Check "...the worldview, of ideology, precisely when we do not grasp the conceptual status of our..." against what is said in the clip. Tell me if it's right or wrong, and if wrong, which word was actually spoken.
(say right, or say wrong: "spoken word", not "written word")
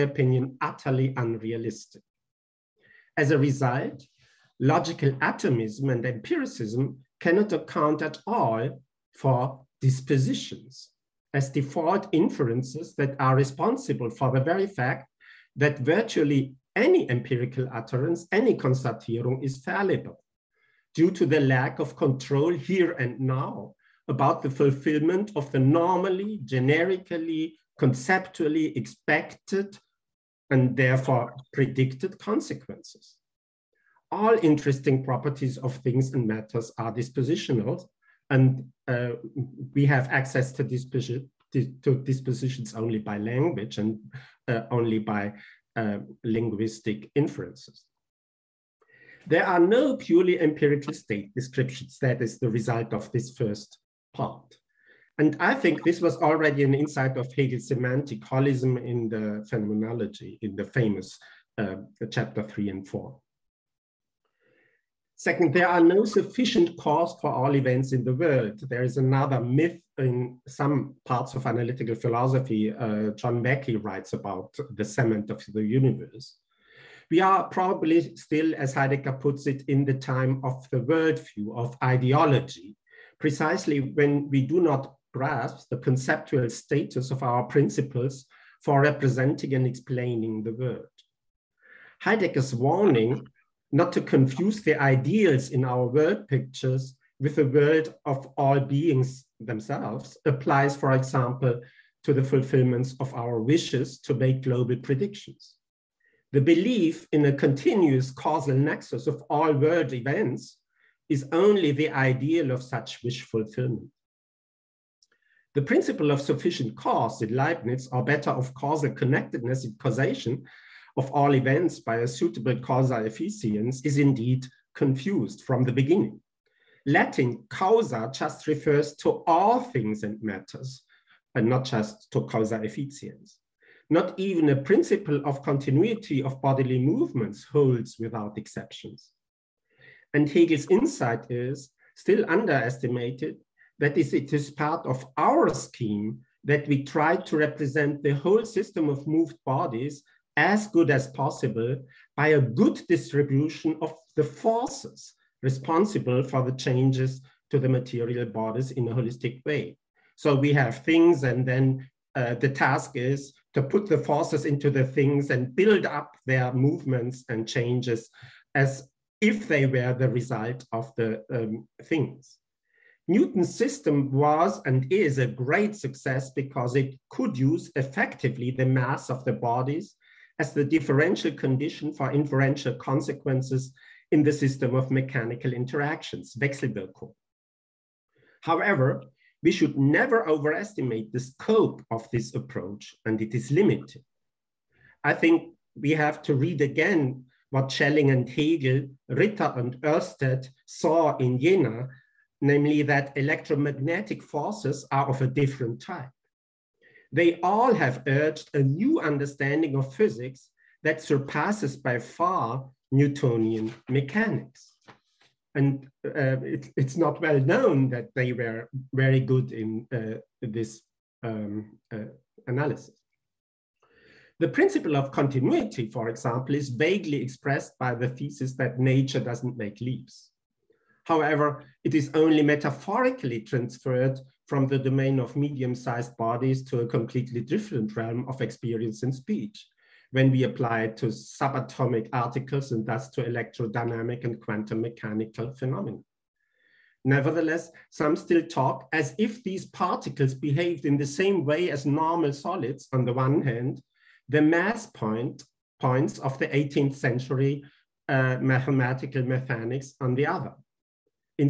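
right.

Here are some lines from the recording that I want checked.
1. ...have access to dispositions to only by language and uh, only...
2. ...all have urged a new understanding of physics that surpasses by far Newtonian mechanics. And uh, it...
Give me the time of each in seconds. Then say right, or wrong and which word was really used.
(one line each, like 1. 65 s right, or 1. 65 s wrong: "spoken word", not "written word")
1. 39 s right
2. 207 s right.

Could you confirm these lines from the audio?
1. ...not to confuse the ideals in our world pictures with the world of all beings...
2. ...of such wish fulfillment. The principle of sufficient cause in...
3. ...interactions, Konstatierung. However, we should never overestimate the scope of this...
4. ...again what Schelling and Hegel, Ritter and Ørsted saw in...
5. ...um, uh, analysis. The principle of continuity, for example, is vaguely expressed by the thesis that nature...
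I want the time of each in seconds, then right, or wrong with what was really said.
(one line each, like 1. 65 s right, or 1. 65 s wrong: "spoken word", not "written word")
1. 93 s right
2. 112 s right
3. 185 s wrong: "Wechselwirkung", not "Konstatierung"
4. 196 s right
5. 221 s right.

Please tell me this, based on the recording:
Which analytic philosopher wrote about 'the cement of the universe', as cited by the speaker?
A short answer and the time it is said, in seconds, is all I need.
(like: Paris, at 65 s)
John Mackie, at 73 s.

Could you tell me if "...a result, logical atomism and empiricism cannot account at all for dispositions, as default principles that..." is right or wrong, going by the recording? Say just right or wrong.
wrong.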